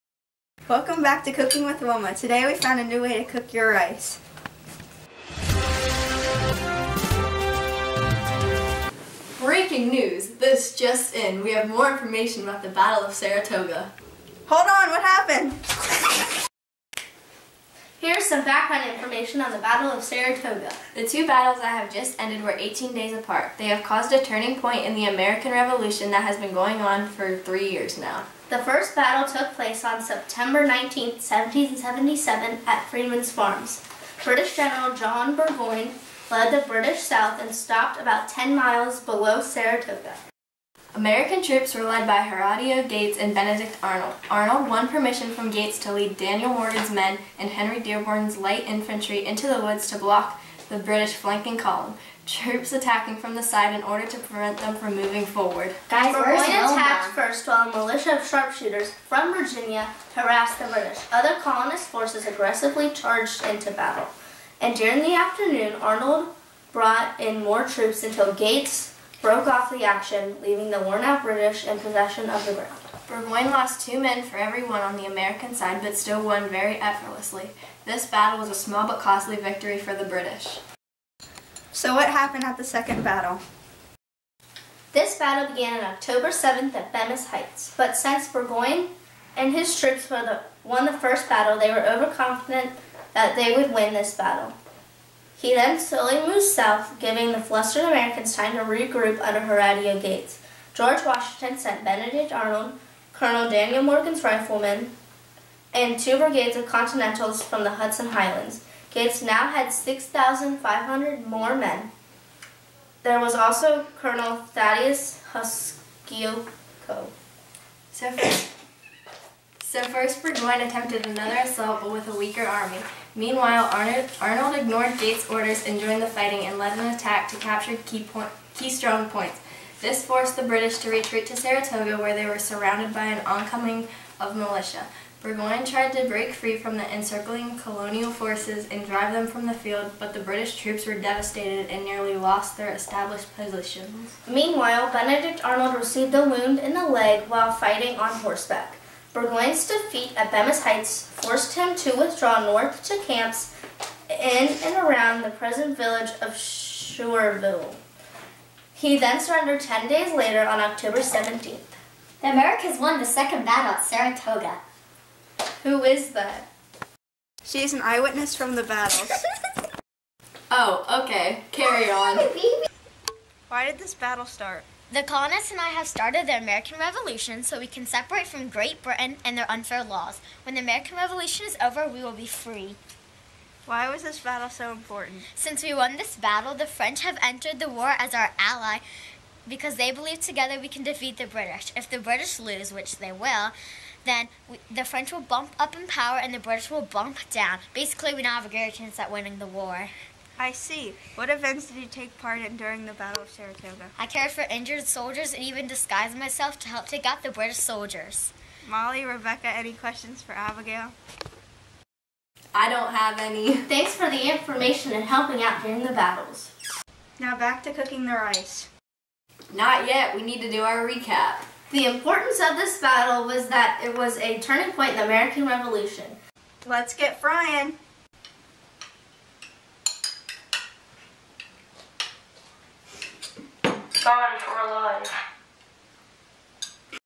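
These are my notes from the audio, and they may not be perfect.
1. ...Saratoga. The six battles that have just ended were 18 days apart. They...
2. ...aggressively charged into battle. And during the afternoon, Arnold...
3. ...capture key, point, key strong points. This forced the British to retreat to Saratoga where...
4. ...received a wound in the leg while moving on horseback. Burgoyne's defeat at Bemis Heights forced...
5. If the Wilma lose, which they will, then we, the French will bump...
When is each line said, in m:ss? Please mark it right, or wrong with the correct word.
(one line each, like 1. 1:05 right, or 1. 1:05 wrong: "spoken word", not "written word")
1. 0:20 wrong: "two", not "six"
2. 1:02 right
3. 2:07 right
4. 2:25 wrong: "fighting", not "moving"
5. 3:11 wrong: "British", not "Wilma".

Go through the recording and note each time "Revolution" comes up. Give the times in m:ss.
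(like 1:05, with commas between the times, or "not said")
0:25, 2:56, 3:00, 3:45.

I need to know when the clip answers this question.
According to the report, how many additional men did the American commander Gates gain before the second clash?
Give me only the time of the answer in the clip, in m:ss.
1:49.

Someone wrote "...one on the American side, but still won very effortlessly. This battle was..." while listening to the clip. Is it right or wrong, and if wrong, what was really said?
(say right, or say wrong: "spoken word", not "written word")
right.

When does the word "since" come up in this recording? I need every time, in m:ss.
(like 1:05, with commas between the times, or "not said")
1:27, 3:05.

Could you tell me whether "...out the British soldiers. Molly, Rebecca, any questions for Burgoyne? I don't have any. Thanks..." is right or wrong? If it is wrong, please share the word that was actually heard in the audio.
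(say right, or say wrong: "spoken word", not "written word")
wrong: "Abigail", not "Burgoyne".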